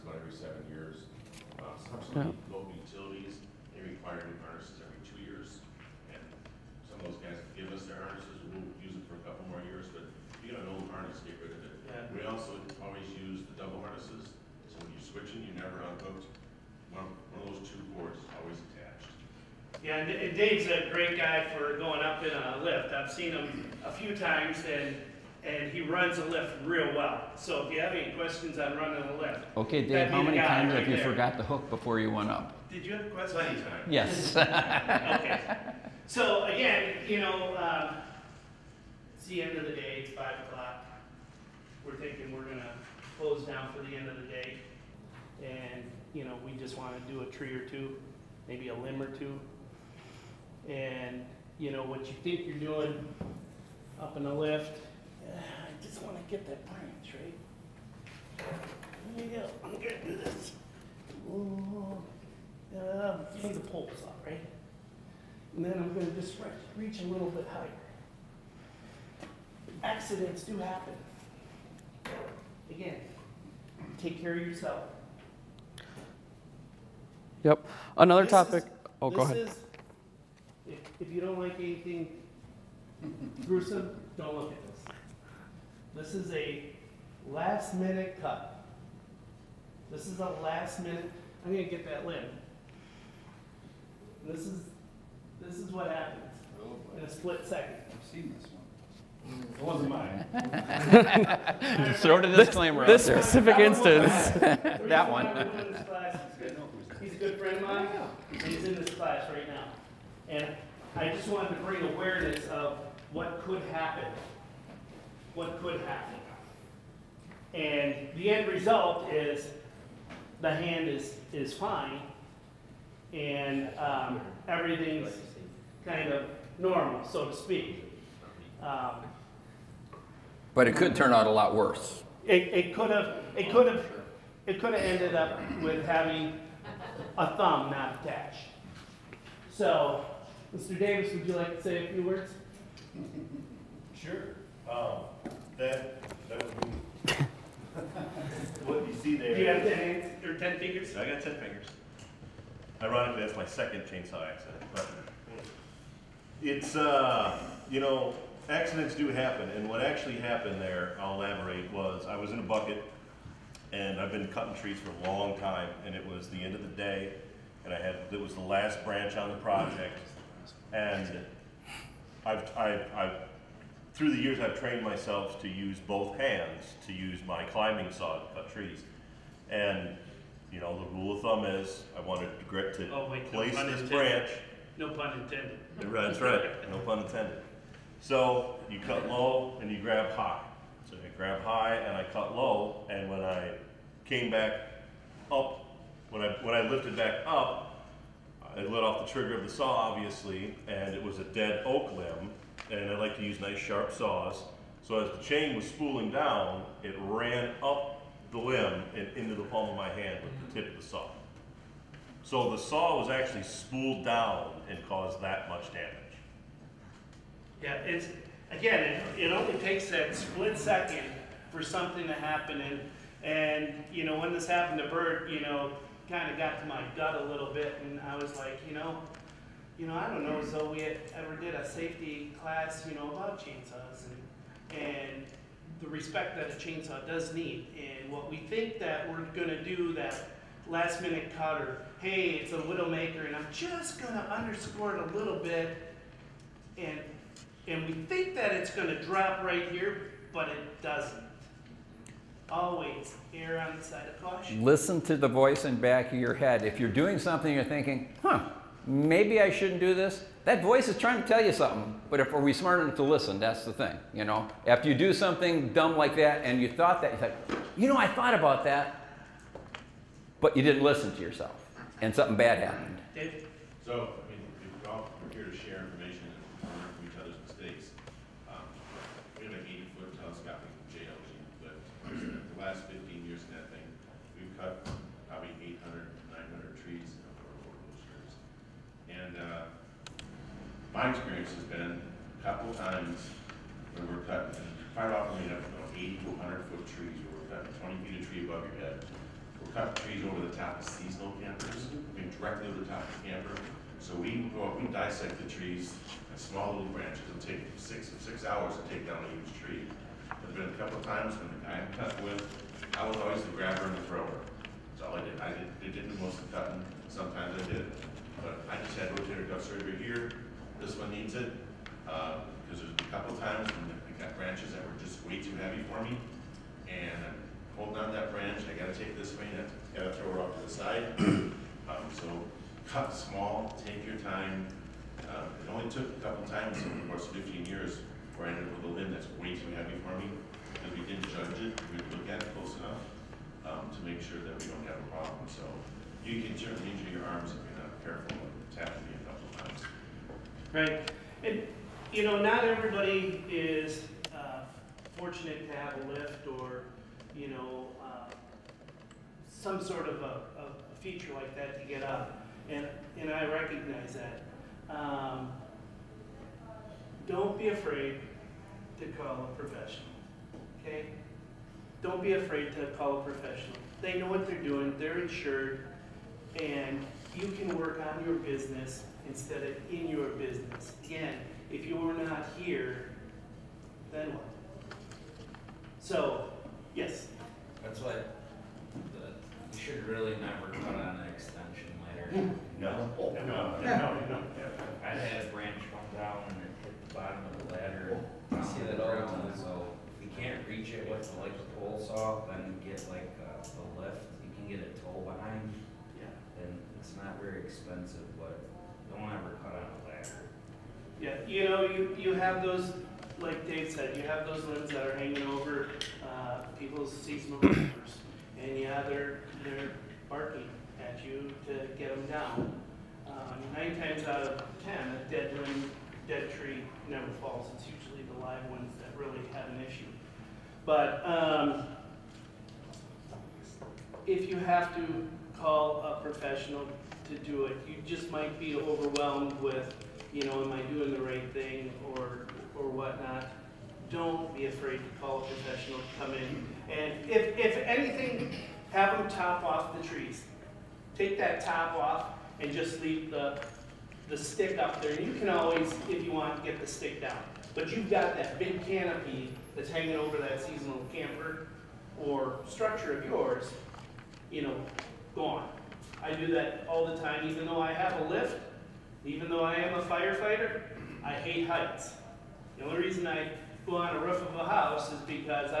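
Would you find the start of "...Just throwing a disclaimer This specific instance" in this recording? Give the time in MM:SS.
01:41.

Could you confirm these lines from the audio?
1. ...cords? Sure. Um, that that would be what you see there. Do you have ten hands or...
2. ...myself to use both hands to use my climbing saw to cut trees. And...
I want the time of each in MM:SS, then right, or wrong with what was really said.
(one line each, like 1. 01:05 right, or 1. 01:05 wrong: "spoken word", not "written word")
1. 02:22 wrong: "words", not "cords"
2. 02:54 right.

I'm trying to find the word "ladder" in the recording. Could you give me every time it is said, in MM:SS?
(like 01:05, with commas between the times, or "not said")
06:32, 06:37, 06:50.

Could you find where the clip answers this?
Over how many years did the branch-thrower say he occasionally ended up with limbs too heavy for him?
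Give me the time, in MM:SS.
05:37.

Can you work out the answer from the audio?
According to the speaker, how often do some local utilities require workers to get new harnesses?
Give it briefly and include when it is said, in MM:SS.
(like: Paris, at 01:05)
every 2 years, at 00:04.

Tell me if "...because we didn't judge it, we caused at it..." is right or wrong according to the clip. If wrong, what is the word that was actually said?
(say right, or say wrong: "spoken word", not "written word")
wrong: "looked", not "caused".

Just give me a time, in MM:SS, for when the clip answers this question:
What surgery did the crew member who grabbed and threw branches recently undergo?
05:19.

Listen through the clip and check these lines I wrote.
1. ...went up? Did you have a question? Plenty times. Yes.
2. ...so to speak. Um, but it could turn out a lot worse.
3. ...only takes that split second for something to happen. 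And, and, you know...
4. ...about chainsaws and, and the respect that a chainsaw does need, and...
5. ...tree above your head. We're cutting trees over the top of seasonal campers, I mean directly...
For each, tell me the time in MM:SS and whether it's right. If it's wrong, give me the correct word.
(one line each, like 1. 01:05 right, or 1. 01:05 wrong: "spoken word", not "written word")
1. 00:32 right
2. 02:07 right
3. 03:39 right
4. 03:53 right
5. 04:58 right.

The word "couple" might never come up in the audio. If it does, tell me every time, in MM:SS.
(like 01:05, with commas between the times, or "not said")
00:09, 04:52, 05:10, 05:23, 05:36.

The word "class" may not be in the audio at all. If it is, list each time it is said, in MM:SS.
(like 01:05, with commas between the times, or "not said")
01:48, 03:52.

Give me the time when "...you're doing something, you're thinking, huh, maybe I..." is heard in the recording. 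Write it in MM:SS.
04:16.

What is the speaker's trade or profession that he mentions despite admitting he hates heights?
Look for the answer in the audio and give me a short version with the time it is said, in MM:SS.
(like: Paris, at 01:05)
firefighter, at 07:50.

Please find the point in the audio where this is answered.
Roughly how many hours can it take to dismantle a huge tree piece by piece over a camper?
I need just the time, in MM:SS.
05:07.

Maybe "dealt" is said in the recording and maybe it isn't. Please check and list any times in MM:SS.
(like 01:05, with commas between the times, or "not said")
not said.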